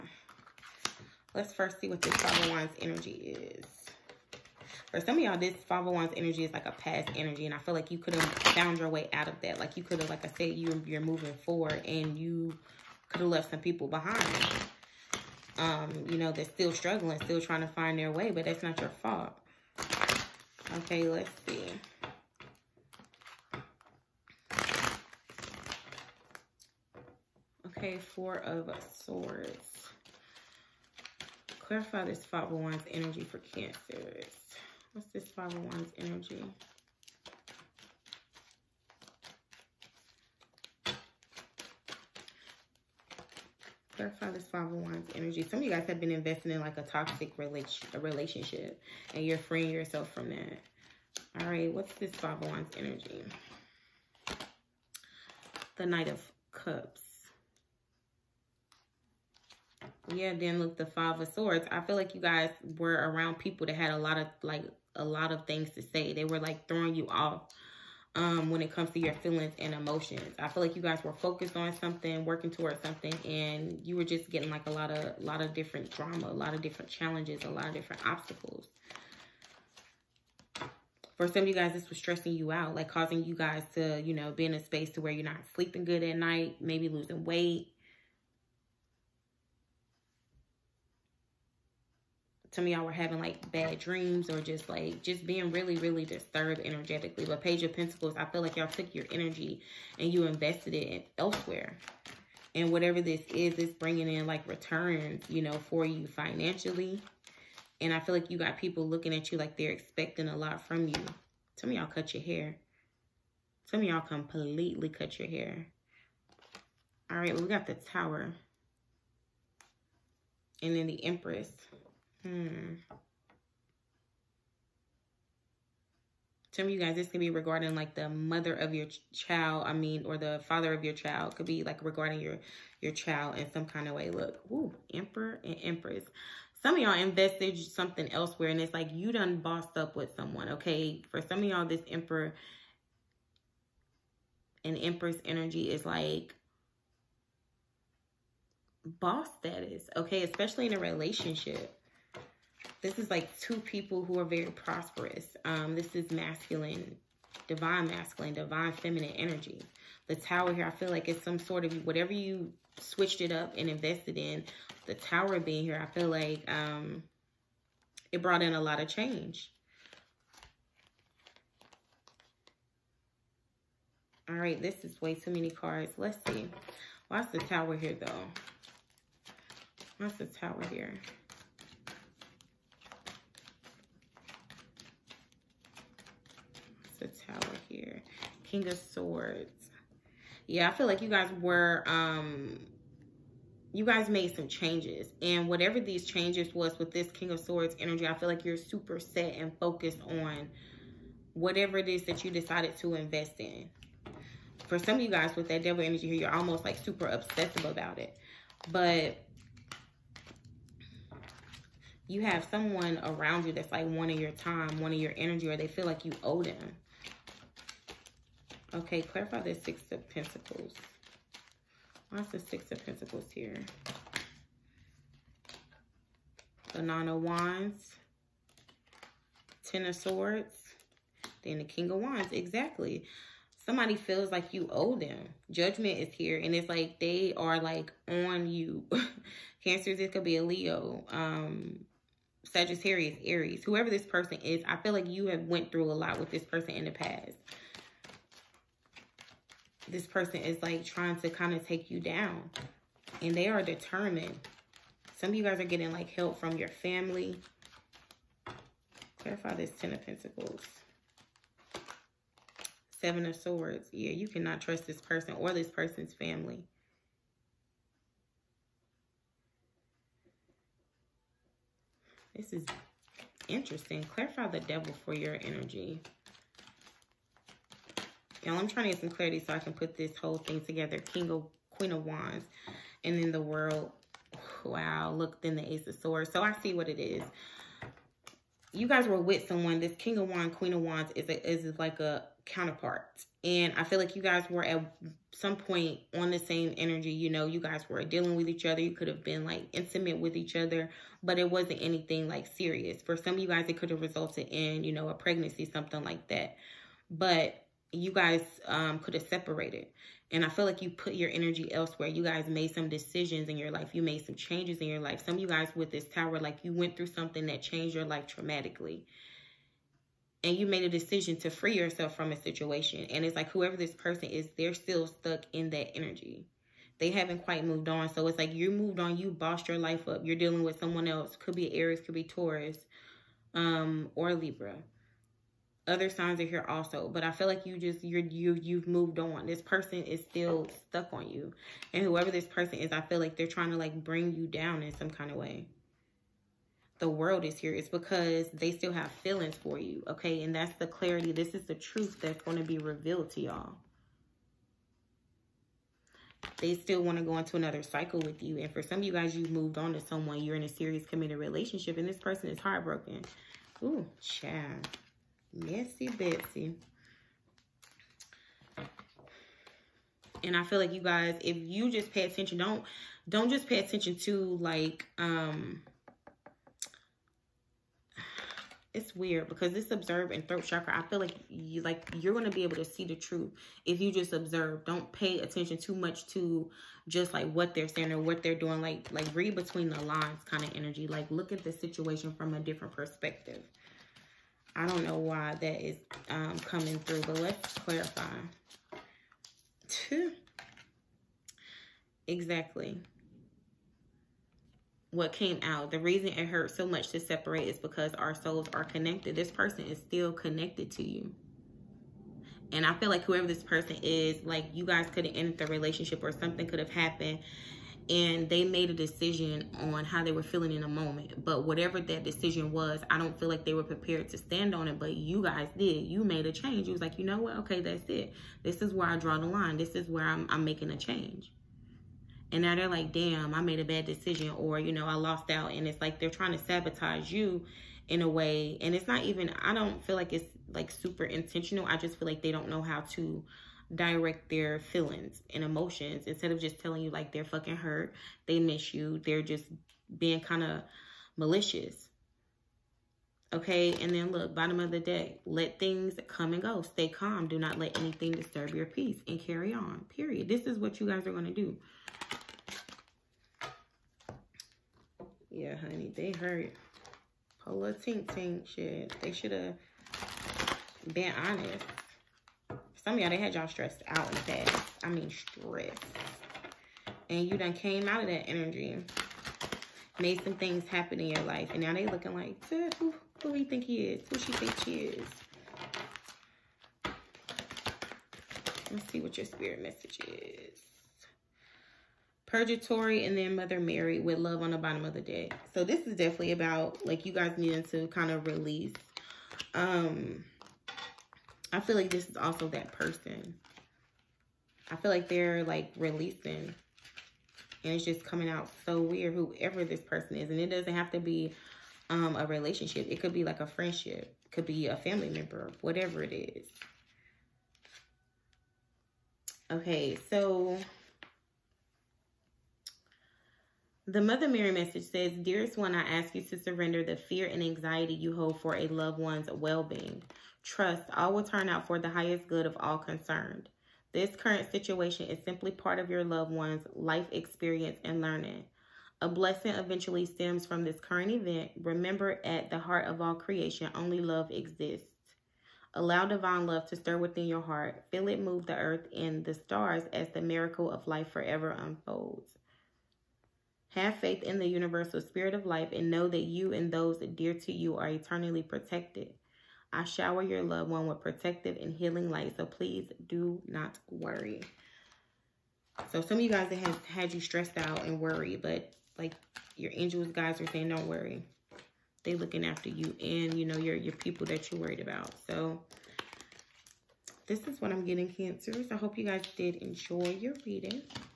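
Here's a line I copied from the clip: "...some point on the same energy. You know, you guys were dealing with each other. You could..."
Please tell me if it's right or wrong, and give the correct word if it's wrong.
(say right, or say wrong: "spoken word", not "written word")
right.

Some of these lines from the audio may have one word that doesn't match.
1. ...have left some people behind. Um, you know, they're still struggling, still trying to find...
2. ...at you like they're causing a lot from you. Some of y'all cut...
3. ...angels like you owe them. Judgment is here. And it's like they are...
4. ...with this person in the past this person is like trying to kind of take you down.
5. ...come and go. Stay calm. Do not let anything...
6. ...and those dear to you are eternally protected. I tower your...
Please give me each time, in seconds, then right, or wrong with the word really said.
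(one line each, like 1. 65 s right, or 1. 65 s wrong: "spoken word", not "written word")
1. 13 s right
2. 109 s wrong: "expecting", not "causing"
3. 233 s wrong: "feels", not "angels"
4. 246 s right
5. 456 s right
6. 556 s wrong: "shower", not "tower".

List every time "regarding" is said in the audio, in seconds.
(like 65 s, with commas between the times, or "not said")
127 s, 131 s.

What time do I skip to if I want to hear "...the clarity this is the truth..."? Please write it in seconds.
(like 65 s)
350 s.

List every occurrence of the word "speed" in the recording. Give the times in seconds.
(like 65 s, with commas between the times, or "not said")
not said.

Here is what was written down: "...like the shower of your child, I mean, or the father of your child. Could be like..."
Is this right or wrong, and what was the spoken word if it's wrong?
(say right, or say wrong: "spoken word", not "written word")
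wrong: "mother", not "shower".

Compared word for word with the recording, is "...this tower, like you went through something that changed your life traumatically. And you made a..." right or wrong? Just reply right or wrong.
right.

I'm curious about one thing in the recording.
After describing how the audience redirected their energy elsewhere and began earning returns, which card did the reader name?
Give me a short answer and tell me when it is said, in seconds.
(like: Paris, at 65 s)
Page of Pentacles, at 97 s.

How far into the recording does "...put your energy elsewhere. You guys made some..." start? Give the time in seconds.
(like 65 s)
310 s.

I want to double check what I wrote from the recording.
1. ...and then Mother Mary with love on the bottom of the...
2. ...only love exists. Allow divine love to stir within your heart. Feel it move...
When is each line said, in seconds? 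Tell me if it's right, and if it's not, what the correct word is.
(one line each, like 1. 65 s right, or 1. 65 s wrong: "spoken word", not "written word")
1. 493 s right
2. 543 s right.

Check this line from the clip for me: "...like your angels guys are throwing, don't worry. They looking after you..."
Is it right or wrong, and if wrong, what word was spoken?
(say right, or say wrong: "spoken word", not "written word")
wrong: "saying", not "throwing".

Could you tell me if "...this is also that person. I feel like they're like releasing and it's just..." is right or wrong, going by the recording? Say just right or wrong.
right.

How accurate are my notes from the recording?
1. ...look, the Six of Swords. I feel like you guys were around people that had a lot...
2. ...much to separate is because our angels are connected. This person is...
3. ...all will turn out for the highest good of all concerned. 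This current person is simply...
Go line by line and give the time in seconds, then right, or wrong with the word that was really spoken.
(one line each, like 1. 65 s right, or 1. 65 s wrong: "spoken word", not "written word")
1. 60 s wrong: "Five", not "Six"
2. 406 s wrong: "souls", not "angels"
3. 531 s wrong: "situation", not "person".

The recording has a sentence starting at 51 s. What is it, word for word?
All right, what's this five of wands energy?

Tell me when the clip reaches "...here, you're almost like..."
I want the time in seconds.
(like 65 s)
206 s.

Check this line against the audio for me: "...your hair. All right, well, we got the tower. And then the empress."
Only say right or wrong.
right.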